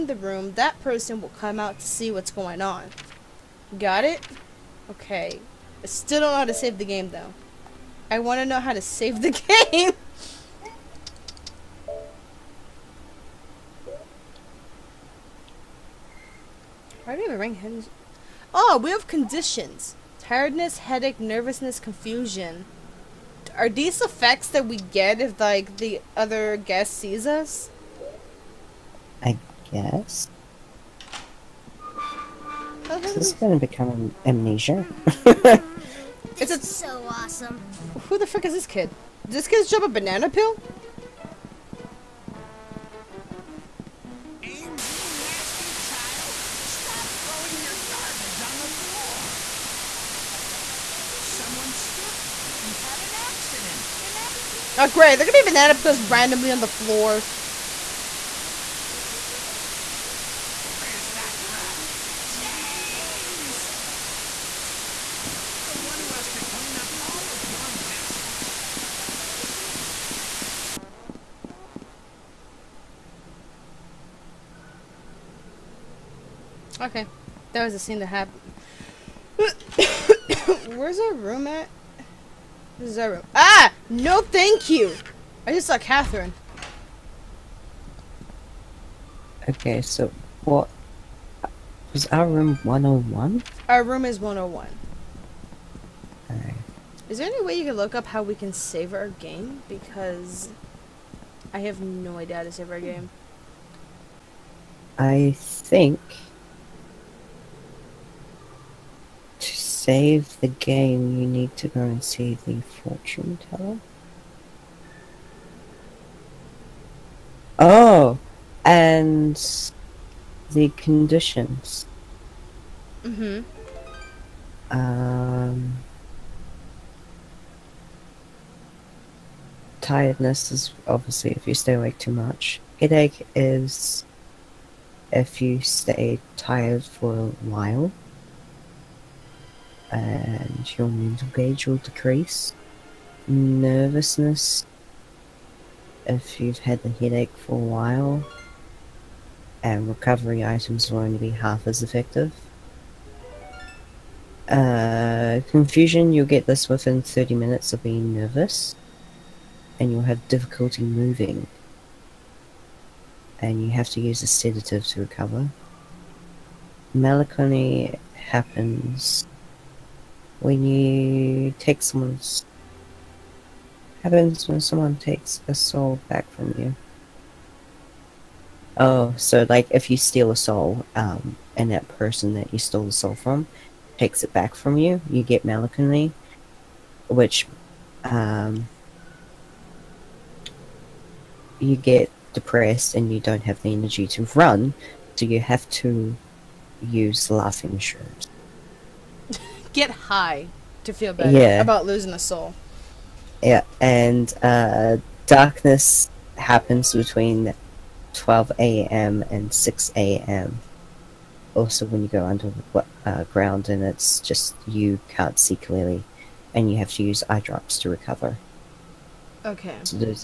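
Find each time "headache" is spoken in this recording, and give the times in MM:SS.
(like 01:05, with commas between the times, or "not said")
00:20, 02:12, 02:26.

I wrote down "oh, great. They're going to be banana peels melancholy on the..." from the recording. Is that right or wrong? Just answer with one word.
wrong.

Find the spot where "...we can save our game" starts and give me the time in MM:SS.
01:38.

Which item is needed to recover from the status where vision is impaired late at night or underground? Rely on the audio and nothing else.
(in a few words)
eye drops.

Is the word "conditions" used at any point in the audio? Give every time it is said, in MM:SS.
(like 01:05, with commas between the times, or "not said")
00:19, 02:00.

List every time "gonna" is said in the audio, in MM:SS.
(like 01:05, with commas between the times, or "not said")
00:33.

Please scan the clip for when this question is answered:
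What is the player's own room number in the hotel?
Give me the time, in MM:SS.
01:33.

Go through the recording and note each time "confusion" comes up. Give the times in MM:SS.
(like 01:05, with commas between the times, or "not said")
00:21, 02:35.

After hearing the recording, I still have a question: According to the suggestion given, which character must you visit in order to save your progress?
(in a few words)
the fortune teller.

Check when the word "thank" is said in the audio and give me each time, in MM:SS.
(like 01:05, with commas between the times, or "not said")
01:24.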